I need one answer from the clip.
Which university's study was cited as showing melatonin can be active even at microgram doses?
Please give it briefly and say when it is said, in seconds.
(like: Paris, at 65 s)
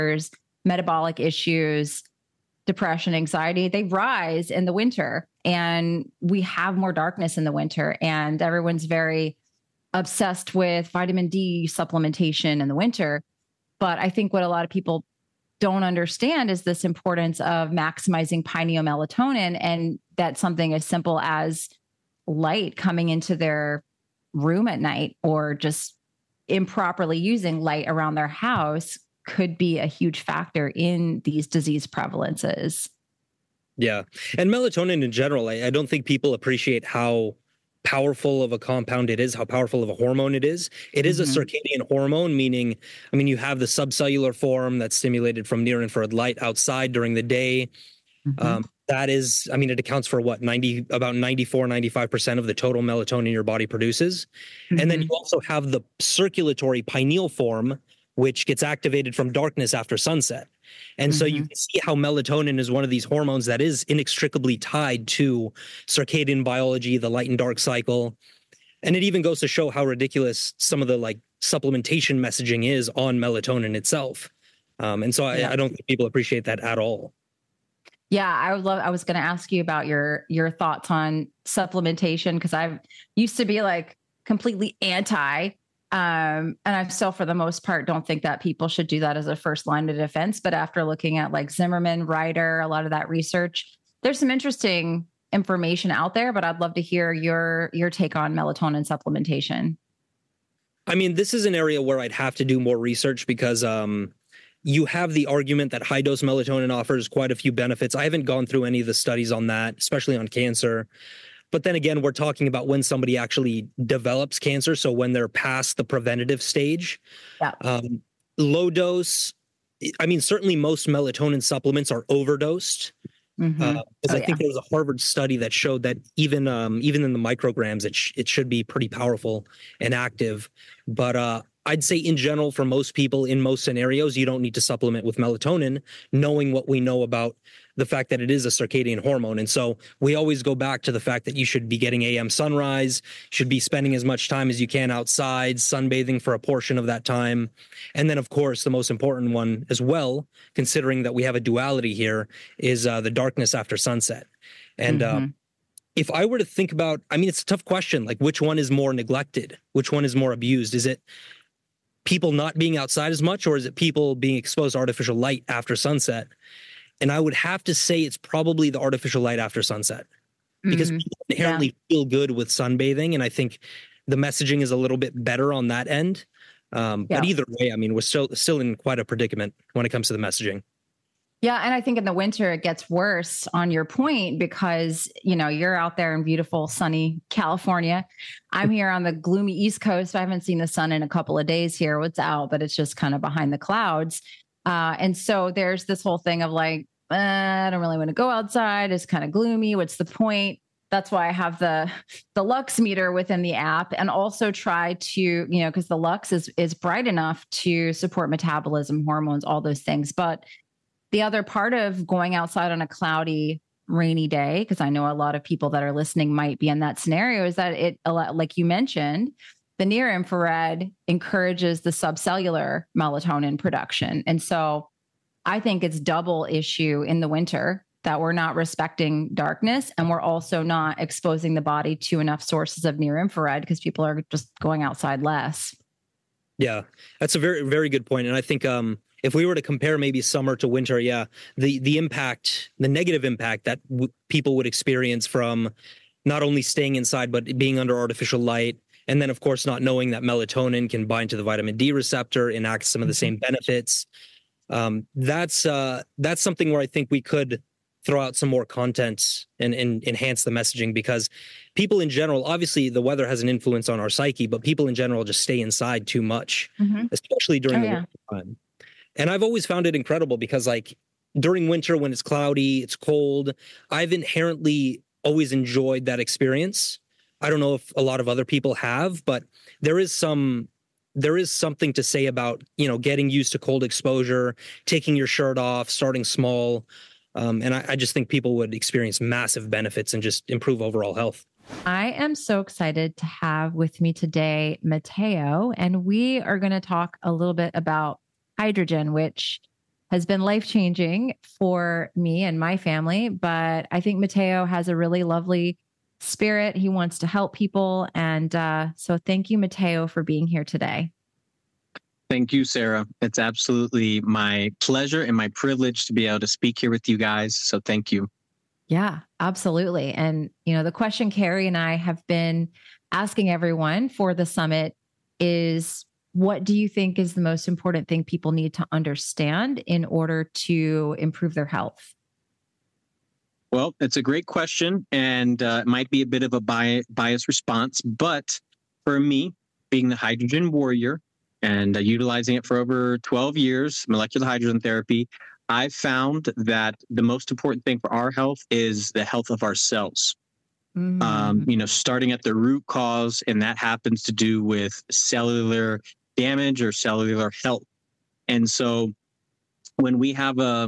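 Harvard, at 124 s.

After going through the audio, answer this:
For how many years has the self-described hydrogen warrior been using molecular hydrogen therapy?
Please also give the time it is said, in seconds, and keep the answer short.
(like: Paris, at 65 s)
12, at 343 s.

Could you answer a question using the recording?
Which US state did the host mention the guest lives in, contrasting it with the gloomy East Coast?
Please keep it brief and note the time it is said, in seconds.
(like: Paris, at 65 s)
California, at 187 s.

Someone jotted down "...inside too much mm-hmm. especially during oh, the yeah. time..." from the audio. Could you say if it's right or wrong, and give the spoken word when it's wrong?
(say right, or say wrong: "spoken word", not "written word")
right.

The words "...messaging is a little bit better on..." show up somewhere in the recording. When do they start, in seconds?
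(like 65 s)
174 s.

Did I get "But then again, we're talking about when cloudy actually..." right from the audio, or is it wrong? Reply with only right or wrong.
wrong.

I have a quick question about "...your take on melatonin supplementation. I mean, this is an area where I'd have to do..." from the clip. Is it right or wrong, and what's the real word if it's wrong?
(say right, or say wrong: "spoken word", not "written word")
right.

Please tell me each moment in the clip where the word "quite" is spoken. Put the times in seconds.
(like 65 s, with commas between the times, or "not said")
107 s, 178 s.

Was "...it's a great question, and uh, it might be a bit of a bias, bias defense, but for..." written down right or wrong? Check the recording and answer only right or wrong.
wrong.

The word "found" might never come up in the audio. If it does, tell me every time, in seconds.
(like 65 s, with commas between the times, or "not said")
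269 s, 345 s.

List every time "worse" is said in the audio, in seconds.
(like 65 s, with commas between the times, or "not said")
182 s.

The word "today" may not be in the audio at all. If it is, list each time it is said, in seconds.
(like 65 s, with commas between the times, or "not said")
294 s, 310 s.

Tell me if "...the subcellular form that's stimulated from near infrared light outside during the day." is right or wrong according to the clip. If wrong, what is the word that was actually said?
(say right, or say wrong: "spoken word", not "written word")
right.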